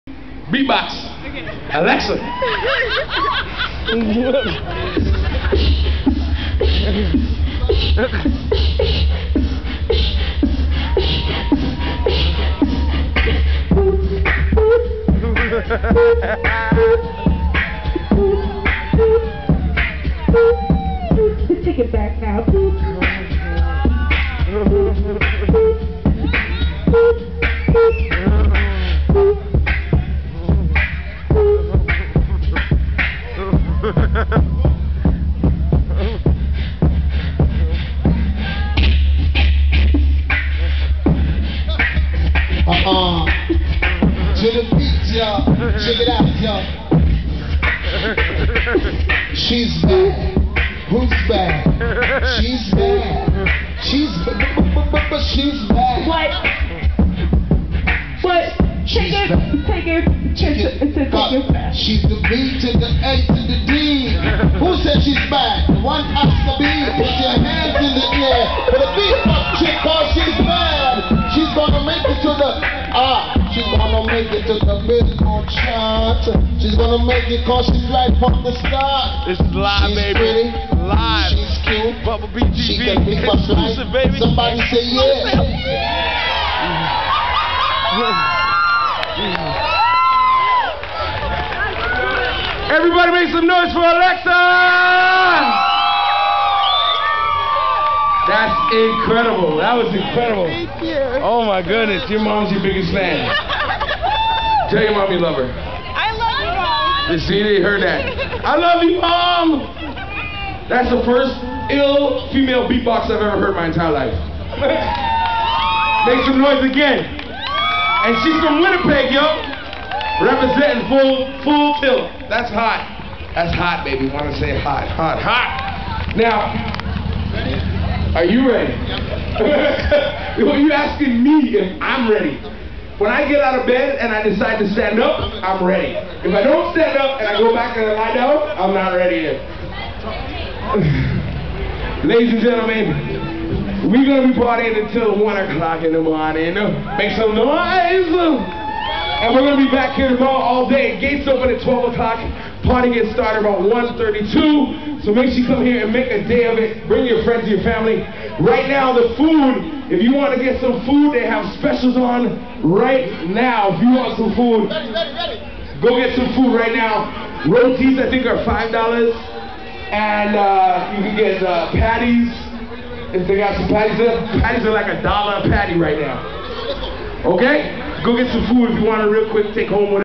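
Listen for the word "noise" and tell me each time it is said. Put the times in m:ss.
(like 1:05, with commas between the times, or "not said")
1:33, 1:56, 2:27.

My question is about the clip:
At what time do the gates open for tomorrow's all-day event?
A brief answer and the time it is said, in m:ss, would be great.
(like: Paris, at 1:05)
12 o'clock, at 2:31.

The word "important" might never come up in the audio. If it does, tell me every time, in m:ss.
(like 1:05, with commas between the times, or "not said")
not said.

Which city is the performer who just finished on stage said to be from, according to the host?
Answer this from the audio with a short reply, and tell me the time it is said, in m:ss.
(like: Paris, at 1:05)
Winnipeg, at 1:58.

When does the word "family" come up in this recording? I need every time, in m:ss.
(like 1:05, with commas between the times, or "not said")
2:37.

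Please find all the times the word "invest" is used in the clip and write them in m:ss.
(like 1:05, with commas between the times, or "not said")
not said.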